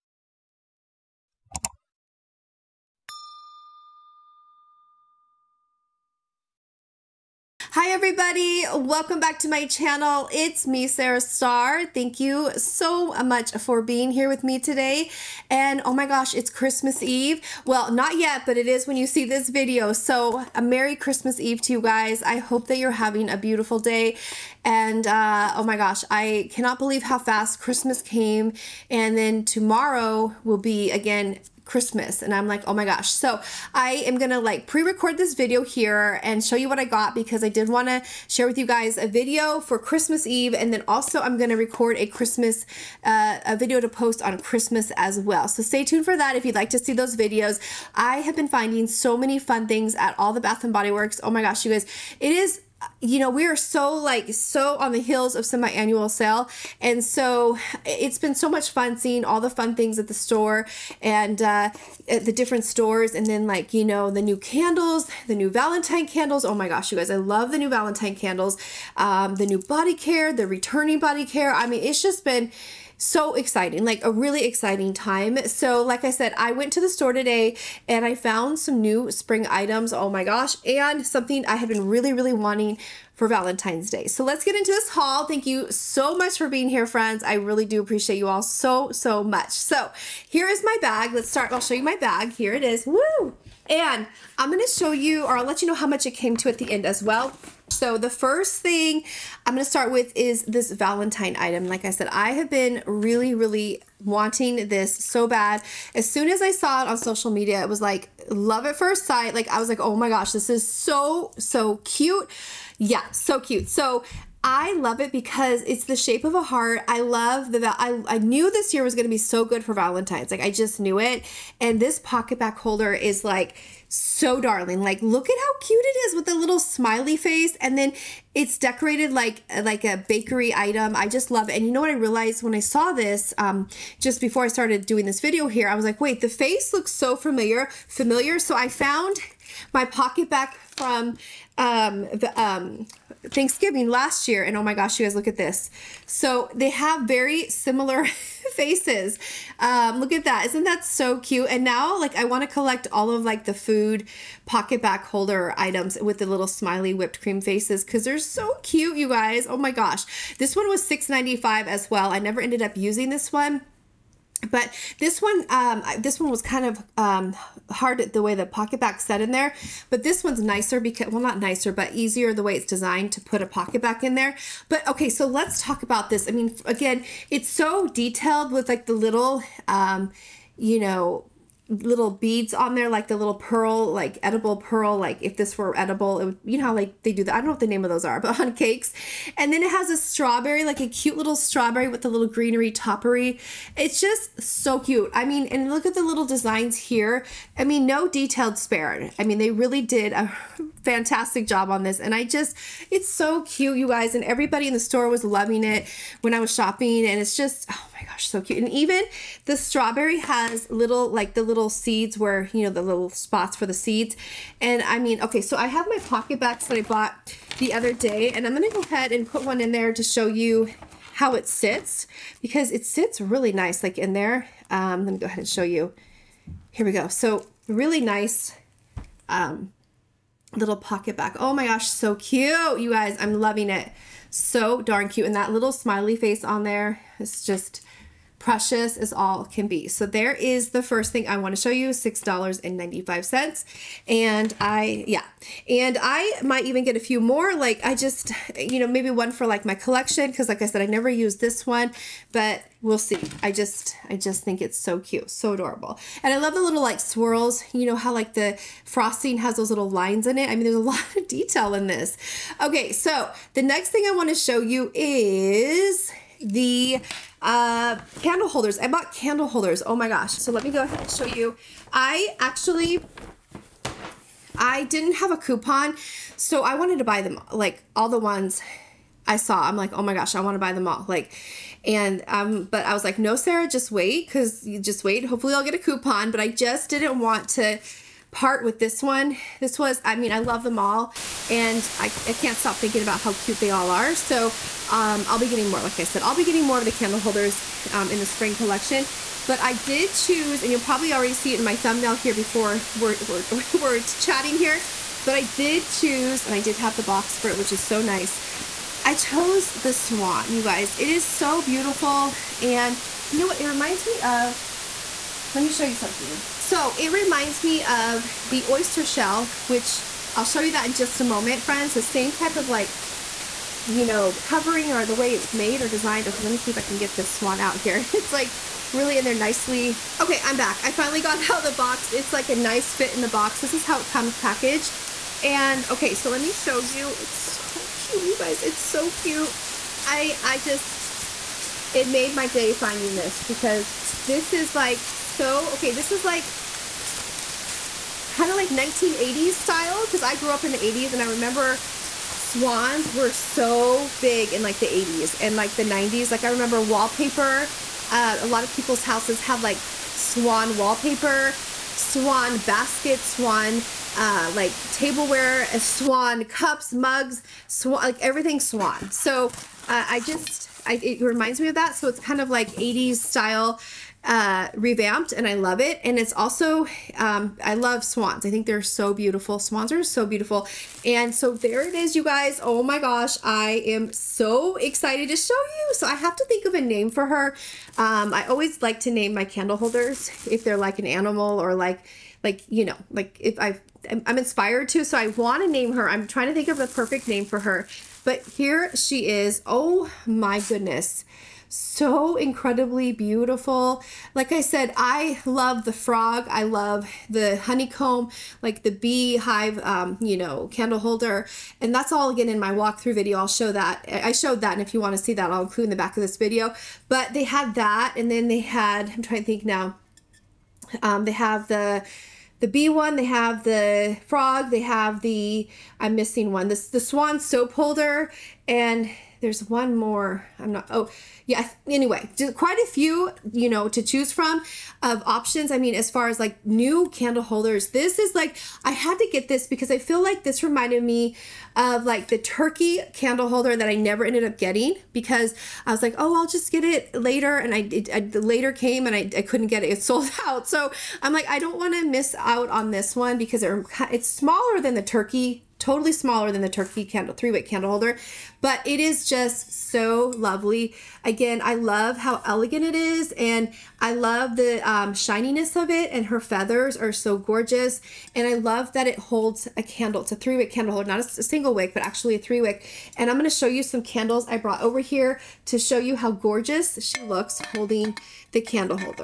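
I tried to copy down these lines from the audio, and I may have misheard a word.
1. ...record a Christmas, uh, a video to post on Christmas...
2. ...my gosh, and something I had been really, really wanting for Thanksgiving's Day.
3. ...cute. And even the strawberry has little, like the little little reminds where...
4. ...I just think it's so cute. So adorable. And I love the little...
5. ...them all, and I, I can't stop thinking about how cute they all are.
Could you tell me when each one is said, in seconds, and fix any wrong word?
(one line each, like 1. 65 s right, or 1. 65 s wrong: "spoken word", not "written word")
1. 41 s right
2. 80 s wrong: "Valentine", not "Thanksgiving"
3. 208 s wrong: "seeds", not "reminds"
4. 254 s right
5. 290 s right.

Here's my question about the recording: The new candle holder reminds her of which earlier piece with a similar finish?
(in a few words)
oyster shell.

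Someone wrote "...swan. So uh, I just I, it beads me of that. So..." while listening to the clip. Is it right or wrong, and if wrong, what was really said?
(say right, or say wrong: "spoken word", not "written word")
wrong: "reminds", not "beads".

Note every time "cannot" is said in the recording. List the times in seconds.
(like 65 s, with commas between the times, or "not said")
26 s.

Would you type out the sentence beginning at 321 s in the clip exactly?
The same type of like, you know, covering or the way it's made or designed.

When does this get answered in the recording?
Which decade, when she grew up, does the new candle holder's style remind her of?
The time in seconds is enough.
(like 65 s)
348 s.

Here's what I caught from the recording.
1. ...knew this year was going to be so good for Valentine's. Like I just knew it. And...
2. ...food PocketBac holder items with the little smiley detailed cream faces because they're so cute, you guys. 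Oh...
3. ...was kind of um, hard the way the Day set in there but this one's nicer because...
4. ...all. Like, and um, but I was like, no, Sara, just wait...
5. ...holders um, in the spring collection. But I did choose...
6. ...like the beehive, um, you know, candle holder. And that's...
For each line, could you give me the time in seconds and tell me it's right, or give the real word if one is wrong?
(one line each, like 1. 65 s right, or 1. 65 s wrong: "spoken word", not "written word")
1. 118 s right
2. 153 s wrong: "whipped", not "detailed"
3. 166 s wrong: "PocketBac", not "Day"
4. 280 s right
5. 297 s right
6. 408 s right.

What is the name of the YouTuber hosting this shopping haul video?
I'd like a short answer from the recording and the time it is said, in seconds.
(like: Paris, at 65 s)
Sara Starr, at 10 s.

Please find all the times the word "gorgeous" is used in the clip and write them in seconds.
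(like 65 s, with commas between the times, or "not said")
467 s, 476 s.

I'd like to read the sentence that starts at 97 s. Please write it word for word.
So the first thing I'm going to start with is this Valentine item.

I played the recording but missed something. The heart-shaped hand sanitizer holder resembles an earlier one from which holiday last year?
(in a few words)
Thanksgiving.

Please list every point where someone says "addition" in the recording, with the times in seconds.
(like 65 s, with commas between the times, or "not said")
not said.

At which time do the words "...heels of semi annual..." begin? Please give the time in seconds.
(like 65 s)
55 s.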